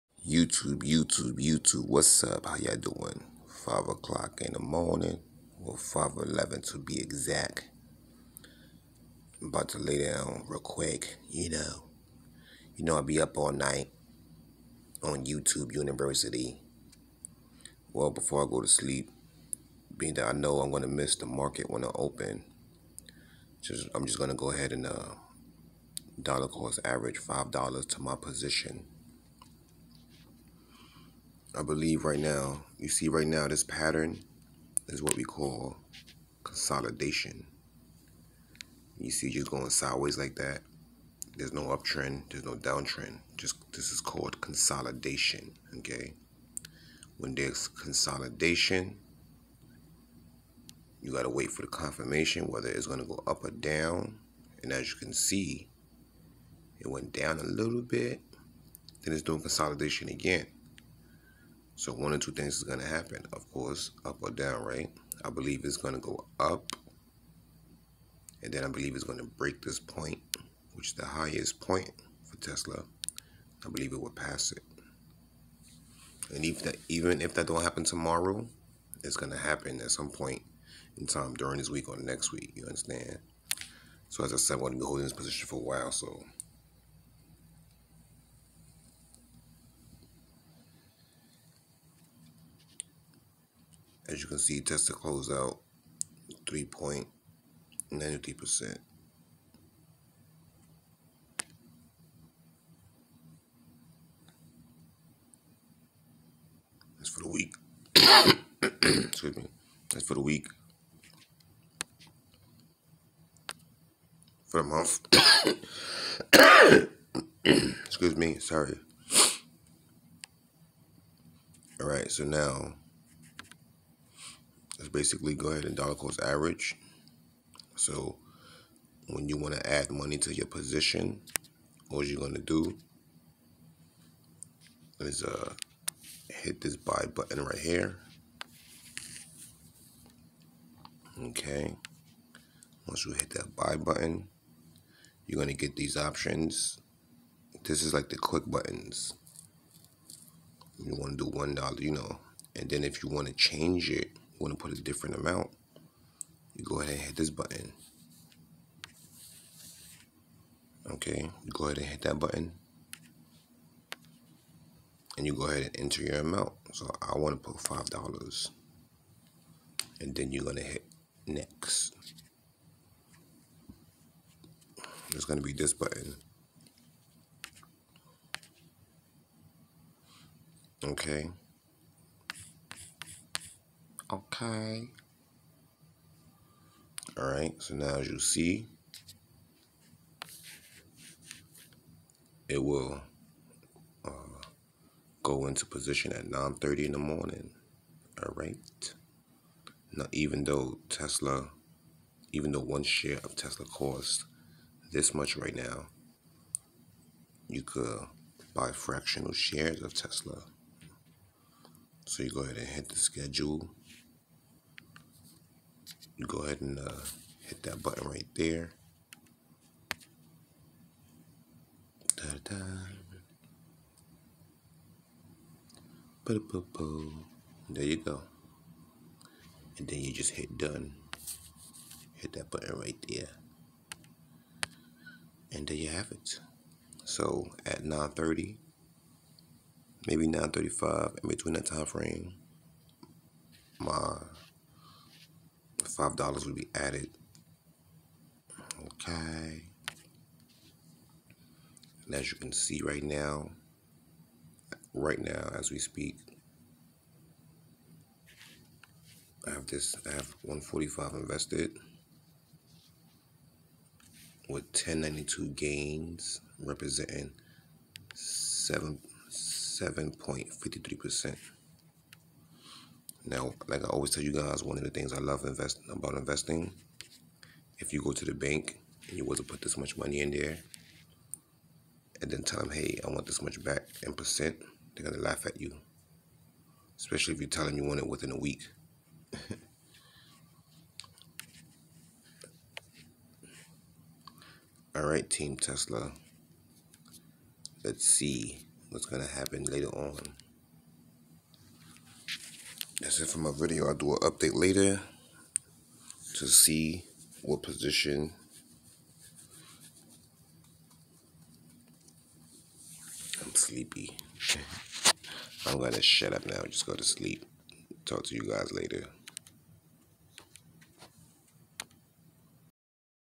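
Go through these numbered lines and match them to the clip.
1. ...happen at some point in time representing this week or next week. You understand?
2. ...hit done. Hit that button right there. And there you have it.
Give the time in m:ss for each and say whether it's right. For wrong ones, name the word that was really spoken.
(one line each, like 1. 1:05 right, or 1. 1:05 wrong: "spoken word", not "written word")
1. 1:19 wrong: "during", not "representing"
2. 3:50 right.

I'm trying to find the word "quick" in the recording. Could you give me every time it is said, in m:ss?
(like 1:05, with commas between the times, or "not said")
0:10, 2:28.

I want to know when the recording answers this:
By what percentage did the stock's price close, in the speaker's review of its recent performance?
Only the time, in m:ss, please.
1:36.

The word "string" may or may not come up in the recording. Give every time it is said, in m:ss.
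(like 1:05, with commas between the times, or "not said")
not said.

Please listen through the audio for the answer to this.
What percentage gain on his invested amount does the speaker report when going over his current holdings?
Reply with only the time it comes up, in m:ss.
4:29.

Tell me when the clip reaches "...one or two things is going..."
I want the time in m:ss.
1:01.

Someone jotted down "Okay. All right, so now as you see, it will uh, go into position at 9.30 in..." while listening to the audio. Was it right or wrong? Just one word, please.
right.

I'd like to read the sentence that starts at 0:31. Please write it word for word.
I believe right now, you see right now, this pattern is what we call consolidation.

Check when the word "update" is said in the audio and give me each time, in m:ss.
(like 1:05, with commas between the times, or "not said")
5:04.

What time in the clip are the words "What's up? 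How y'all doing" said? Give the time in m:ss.
0:01.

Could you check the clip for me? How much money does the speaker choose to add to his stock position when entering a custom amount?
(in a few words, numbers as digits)
$5.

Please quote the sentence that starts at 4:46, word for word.
Especially if you tell them you want it within a week.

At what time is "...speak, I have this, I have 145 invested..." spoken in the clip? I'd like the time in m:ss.
4:15.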